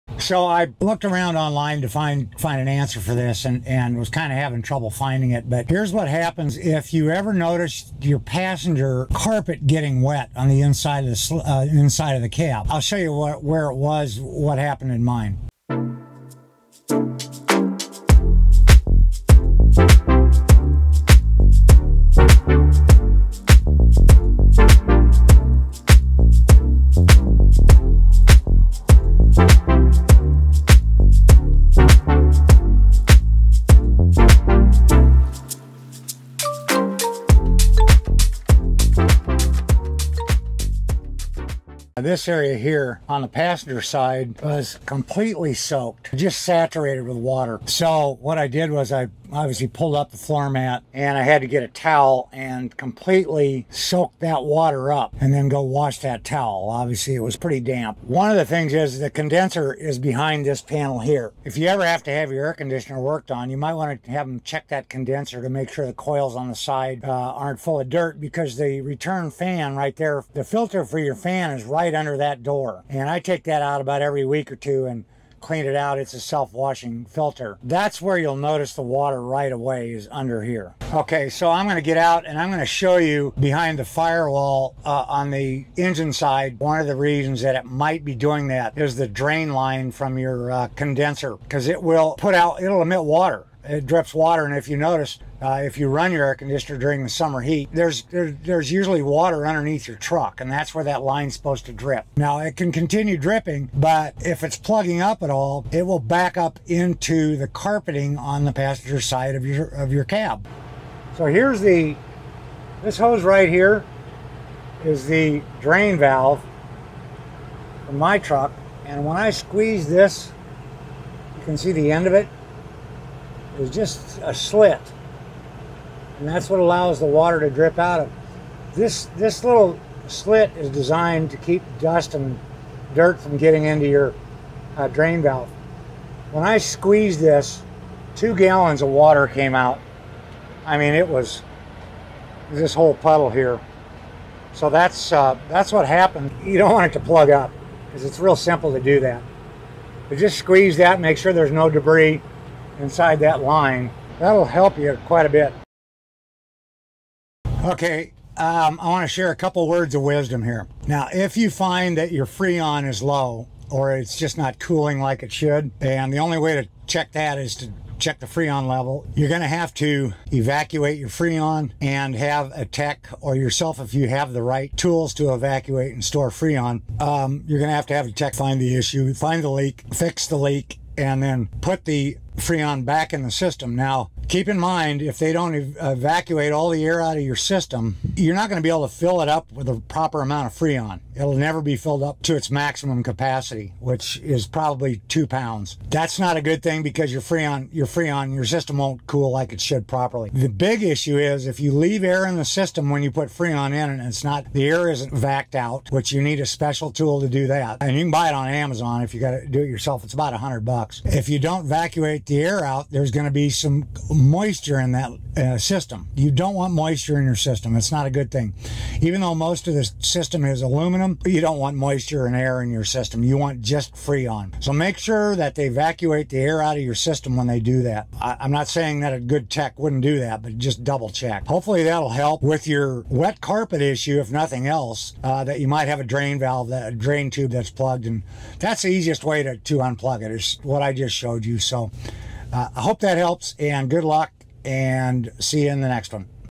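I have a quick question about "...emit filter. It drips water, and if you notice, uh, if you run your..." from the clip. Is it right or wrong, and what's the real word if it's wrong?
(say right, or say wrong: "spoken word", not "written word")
wrong: "water", not "filter".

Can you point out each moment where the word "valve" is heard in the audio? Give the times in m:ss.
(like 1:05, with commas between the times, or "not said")
1:55, 2:15, 3:56.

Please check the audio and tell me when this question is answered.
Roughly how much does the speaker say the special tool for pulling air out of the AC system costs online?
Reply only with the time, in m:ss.
3:30.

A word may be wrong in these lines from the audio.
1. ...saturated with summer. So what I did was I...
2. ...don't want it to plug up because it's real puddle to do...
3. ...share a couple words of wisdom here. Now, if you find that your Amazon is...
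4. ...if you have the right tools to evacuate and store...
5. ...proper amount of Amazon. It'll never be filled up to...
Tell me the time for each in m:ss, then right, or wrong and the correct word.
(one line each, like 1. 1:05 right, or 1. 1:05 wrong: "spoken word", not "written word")
1. 0:46 wrong: "water", not "summer"
2. 2:26 wrong: "simple", not "puddle"
3. 2:39 wrong: "Freon", not "Amazon"
4. 2:53 right
5. 3:09 wrong: "Freon", not "Amazon".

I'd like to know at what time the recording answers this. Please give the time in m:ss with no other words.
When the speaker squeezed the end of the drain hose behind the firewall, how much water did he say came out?
2:18.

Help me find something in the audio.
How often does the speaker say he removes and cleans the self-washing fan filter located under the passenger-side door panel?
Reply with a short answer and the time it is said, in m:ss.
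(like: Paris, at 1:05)
every week or two, at 1:14.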